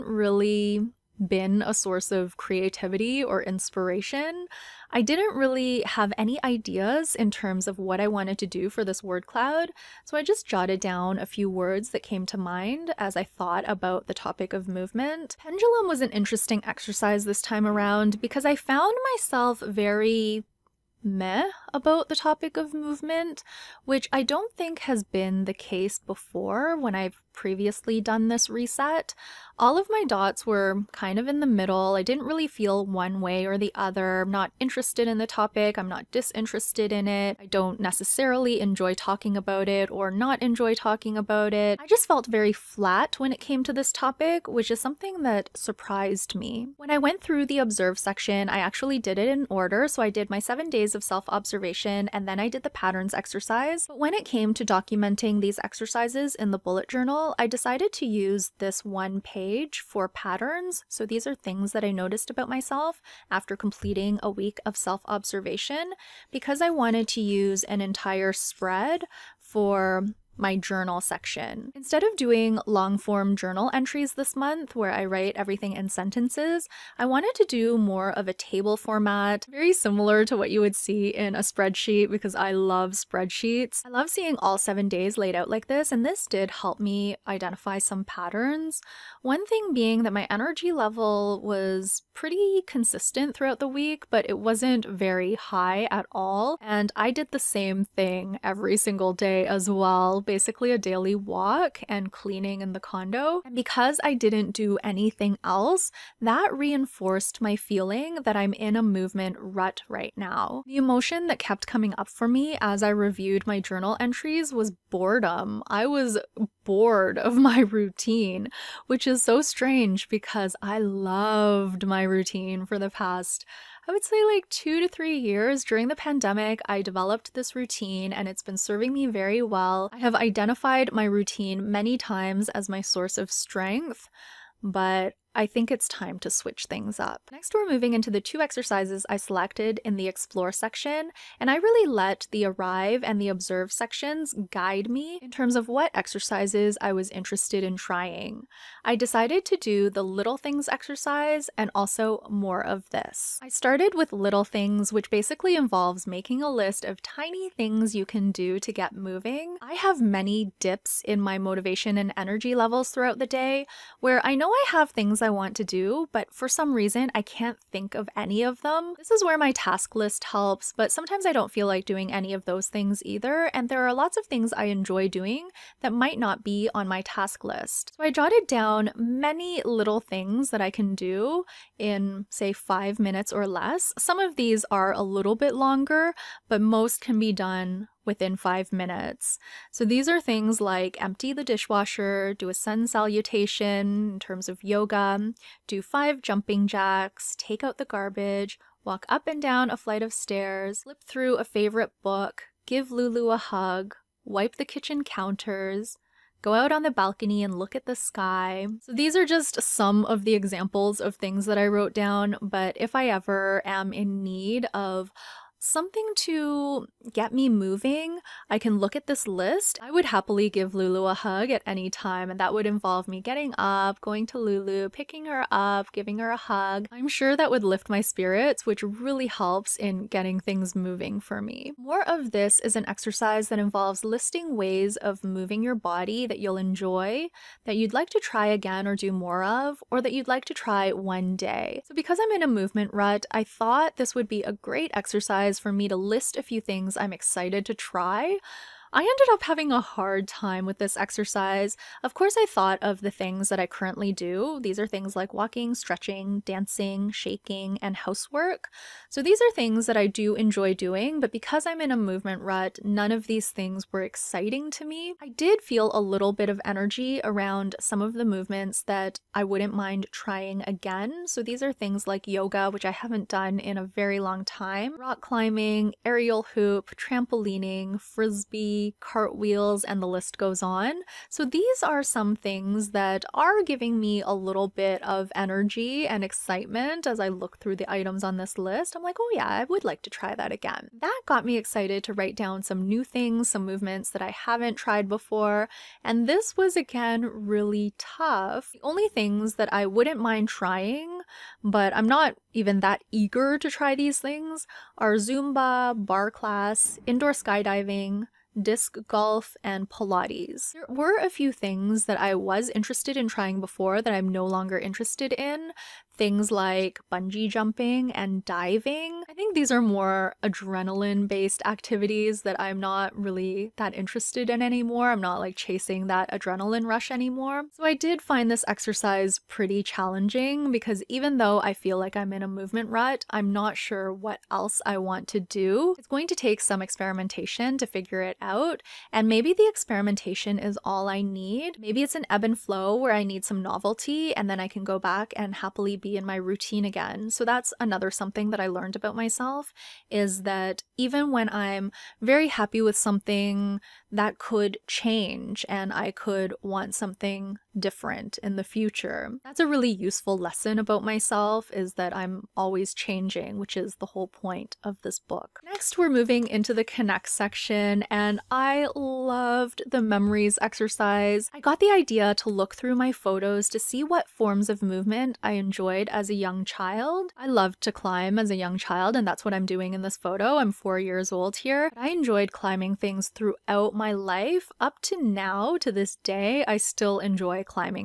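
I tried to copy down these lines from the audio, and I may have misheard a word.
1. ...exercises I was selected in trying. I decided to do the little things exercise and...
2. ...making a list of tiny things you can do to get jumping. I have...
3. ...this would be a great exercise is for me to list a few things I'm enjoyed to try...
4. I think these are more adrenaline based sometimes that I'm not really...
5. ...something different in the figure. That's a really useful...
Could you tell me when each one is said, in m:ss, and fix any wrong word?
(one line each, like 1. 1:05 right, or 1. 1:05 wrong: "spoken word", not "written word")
1. 2:25 wrong: "interested", not "selected"
2. 2:36 wrong: "moving", not "jumping"
3. 4:03 wrong: "excited", not "enjoyed"
4. 5:19 wrong: "activities", not "sometimes"
5. 5:56 wrong: "future", not "figure".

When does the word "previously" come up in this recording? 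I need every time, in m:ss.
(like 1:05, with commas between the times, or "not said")
0:27.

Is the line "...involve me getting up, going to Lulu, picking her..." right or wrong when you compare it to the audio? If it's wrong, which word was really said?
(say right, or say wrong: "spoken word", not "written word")
right.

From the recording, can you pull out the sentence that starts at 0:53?
But when it came to documenting these exercises in the bullet journal, I decided to use this one page for patterns.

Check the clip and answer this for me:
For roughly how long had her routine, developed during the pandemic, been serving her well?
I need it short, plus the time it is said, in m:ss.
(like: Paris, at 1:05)
2 to 3 years, at 2:04.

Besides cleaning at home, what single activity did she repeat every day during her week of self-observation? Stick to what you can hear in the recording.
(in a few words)
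a daily walk.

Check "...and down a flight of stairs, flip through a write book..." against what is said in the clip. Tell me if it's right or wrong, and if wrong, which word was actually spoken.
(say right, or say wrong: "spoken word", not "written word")
wrong: "favorite", not "write".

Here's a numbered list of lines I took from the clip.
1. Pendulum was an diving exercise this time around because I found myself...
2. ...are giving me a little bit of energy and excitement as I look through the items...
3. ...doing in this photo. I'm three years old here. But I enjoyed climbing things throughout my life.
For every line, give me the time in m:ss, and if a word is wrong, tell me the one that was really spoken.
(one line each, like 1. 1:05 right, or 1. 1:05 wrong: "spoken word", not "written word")
1. 0:15 wrong: "interesting", not "diving"
2. 4:43 right
3. 6:19 wrong: "four", not "three".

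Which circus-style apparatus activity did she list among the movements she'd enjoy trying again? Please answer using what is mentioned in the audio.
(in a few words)
aerial hoop.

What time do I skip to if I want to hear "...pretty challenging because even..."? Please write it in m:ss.
5:29.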